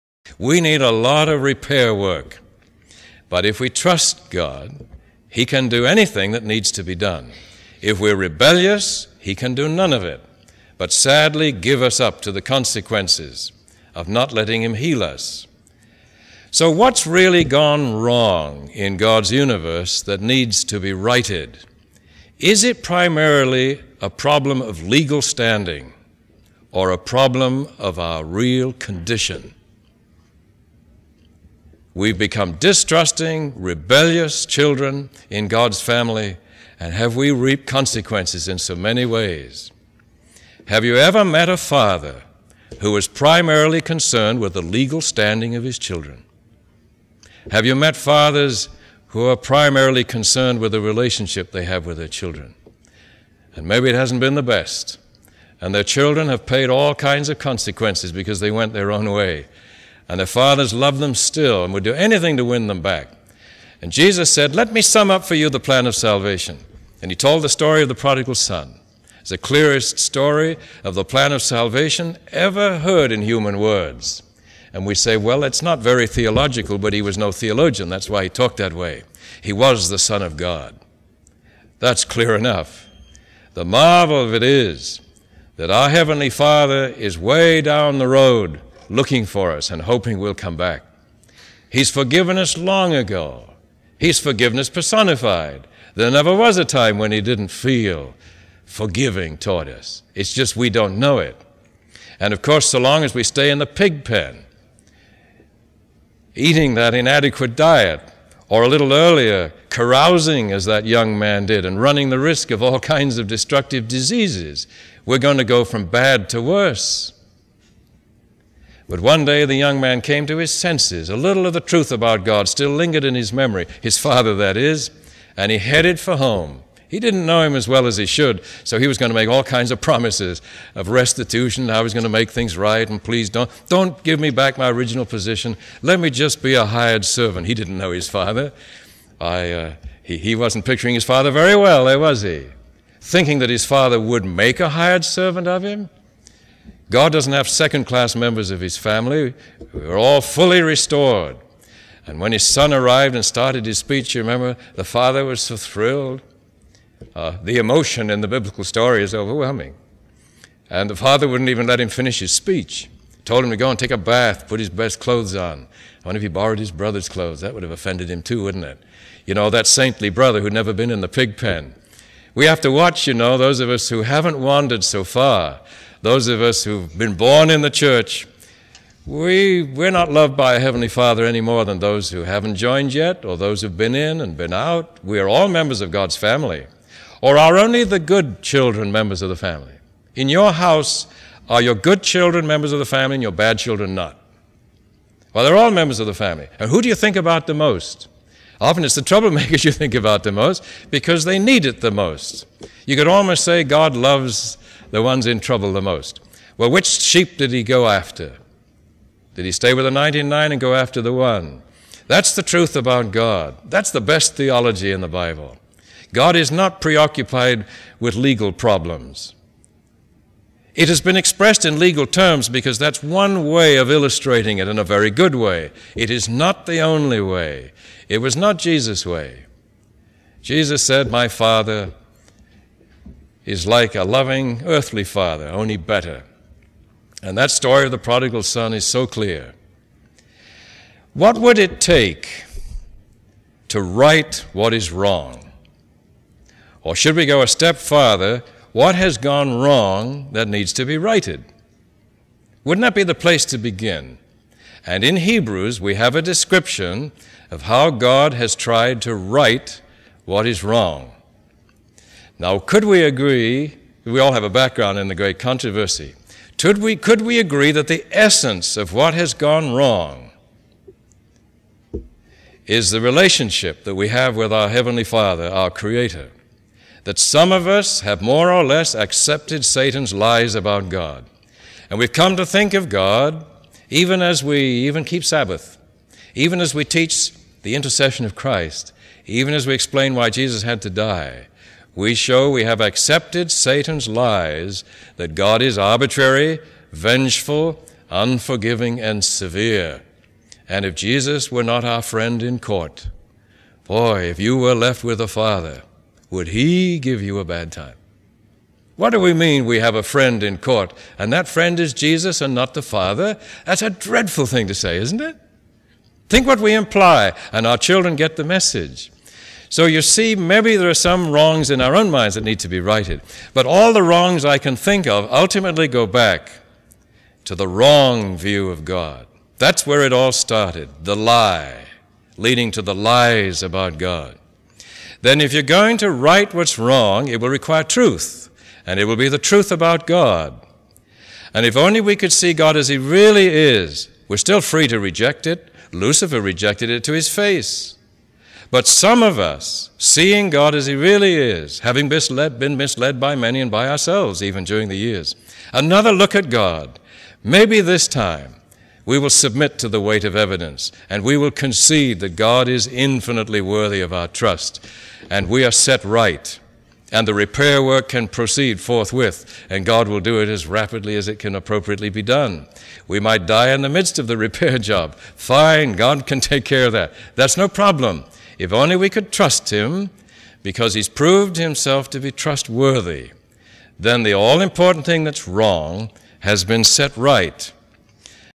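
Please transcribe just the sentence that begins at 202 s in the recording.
You could almost say God loves the ones in trouble the most.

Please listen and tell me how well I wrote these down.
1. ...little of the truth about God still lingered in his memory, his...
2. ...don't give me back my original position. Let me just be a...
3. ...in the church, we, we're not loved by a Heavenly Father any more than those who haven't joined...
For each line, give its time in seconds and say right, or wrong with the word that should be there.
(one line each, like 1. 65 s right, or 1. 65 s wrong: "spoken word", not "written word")
1. 121 s right
2. 133 s right
3. 177 s right.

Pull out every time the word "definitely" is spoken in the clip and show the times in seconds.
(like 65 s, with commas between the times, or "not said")
not said.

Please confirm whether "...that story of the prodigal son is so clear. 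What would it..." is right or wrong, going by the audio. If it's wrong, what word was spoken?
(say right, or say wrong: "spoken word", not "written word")
right.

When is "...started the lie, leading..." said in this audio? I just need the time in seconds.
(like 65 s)
330 s.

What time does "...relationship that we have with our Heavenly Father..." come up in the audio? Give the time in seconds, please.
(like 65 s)
272 s.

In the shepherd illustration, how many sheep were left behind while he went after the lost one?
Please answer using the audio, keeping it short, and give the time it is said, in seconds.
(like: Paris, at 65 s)
99, at 209 s.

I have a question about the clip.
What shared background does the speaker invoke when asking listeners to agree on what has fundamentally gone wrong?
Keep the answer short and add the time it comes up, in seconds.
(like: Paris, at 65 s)
The great controversy, at 265 s.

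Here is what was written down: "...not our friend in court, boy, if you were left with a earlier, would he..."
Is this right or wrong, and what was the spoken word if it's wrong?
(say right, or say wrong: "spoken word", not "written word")
wrong: "father", not "earlier".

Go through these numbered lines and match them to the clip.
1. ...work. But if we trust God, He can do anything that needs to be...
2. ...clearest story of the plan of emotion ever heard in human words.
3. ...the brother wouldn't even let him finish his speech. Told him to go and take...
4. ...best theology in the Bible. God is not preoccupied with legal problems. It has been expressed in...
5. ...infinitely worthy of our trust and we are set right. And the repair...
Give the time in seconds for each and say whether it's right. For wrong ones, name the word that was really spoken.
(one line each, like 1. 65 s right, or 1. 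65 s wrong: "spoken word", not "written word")
1. 1 s right
2. 69 s wrong: "salvation", not "emotion"
3. 160 s wrong: "father", not "brother"
4. 214 s right
5. 362 s right.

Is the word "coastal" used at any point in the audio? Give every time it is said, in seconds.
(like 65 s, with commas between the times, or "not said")
not said.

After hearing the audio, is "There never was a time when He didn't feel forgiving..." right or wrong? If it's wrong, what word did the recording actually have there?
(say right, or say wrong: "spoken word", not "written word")
right.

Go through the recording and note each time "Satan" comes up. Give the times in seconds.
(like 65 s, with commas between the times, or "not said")
279 s, 293 s.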